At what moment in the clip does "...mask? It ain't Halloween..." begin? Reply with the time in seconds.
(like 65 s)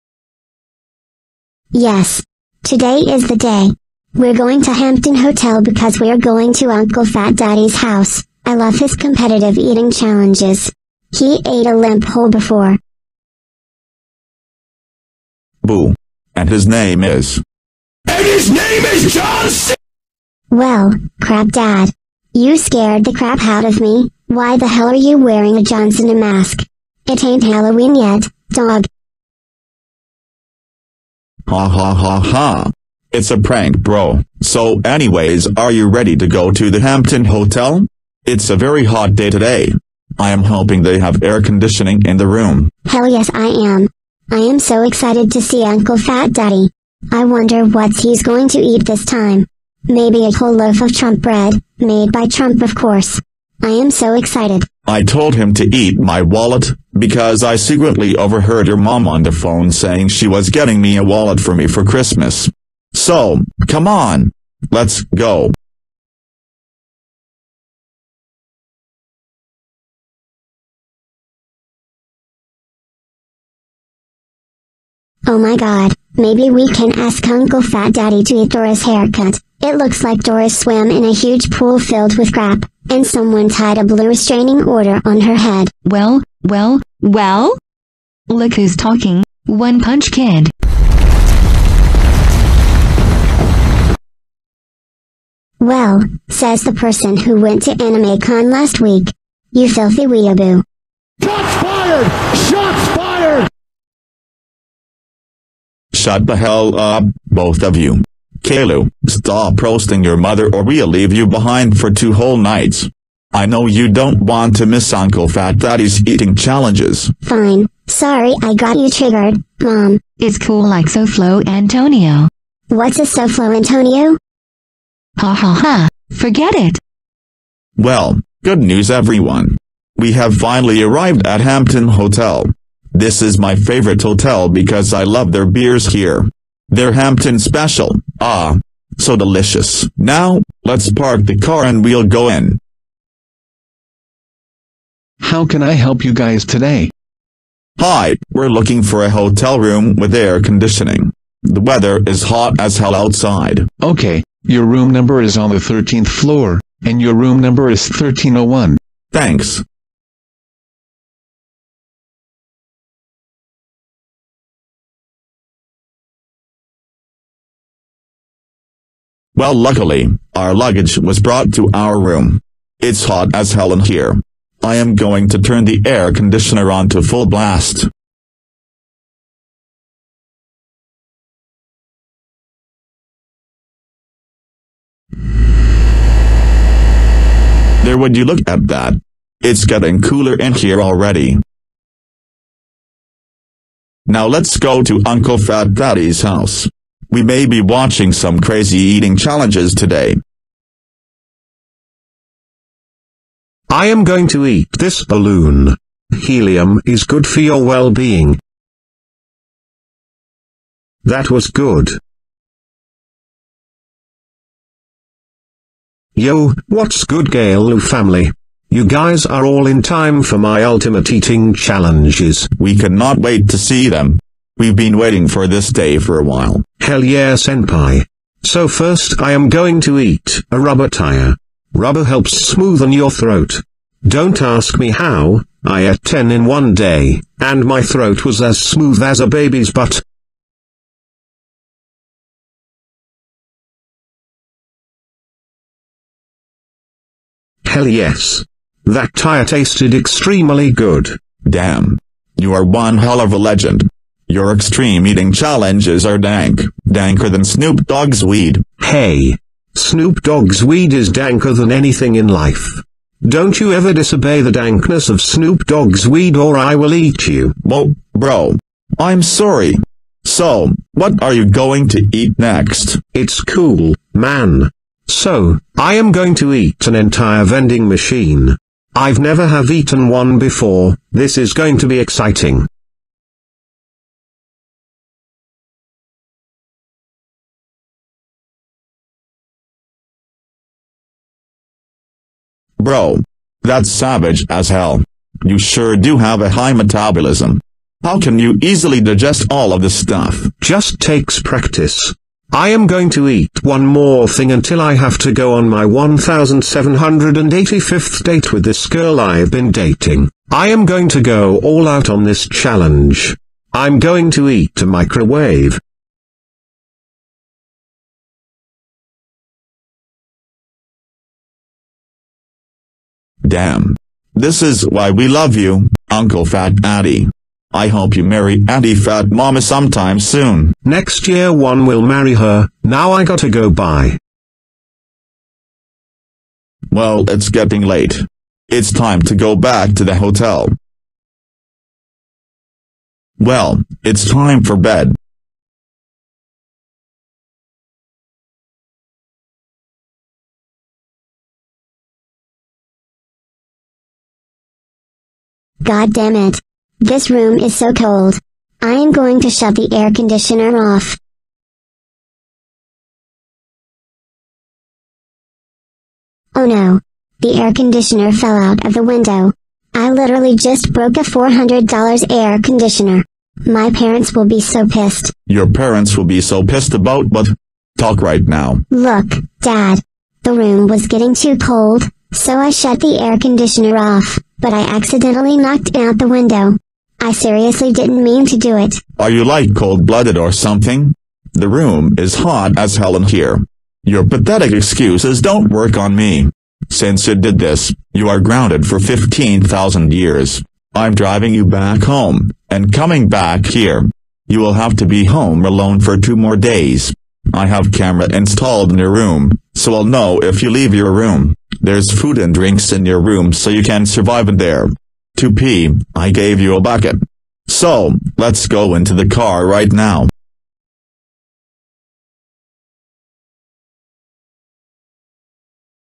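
26 s.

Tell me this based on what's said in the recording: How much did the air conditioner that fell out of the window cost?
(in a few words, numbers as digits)
$400.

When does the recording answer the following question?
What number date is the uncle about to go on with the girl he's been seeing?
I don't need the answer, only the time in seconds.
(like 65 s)
305 s.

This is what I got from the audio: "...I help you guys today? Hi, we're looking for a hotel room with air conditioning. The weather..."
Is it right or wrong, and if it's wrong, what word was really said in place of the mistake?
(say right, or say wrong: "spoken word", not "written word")
right.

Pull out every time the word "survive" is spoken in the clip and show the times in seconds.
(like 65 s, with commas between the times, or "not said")
414 s.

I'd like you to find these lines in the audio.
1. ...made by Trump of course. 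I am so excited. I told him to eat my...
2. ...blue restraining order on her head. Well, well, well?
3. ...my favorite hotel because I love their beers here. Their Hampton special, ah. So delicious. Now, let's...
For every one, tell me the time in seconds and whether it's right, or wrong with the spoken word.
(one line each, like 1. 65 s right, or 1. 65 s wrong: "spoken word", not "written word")
1. 51 s right
2. 83 s right
3. 133 s right.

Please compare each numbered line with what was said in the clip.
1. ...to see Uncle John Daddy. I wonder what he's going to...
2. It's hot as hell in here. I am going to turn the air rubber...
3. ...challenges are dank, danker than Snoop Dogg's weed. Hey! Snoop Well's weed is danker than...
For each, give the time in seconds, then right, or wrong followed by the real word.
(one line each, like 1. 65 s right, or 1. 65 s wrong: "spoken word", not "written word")
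1. 45 s wrong: "Fat", not "John"
2. 172 s wrong: "conditioner", not "rubber"
3. 255 s wrong: "Dogg", not "Well".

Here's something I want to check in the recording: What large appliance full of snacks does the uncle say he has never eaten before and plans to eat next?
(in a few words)
An entire vending machine.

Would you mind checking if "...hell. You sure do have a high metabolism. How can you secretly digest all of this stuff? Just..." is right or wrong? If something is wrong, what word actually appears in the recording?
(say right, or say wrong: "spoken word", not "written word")
wrong: "easily", not "secretly".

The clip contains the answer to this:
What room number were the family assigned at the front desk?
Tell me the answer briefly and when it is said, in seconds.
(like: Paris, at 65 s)
1301, at 157 s.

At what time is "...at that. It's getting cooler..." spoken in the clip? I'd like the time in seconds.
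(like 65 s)
188 s.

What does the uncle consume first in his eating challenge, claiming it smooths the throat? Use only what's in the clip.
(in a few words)
A rubber tire.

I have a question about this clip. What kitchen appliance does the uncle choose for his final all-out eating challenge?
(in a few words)
A microwave.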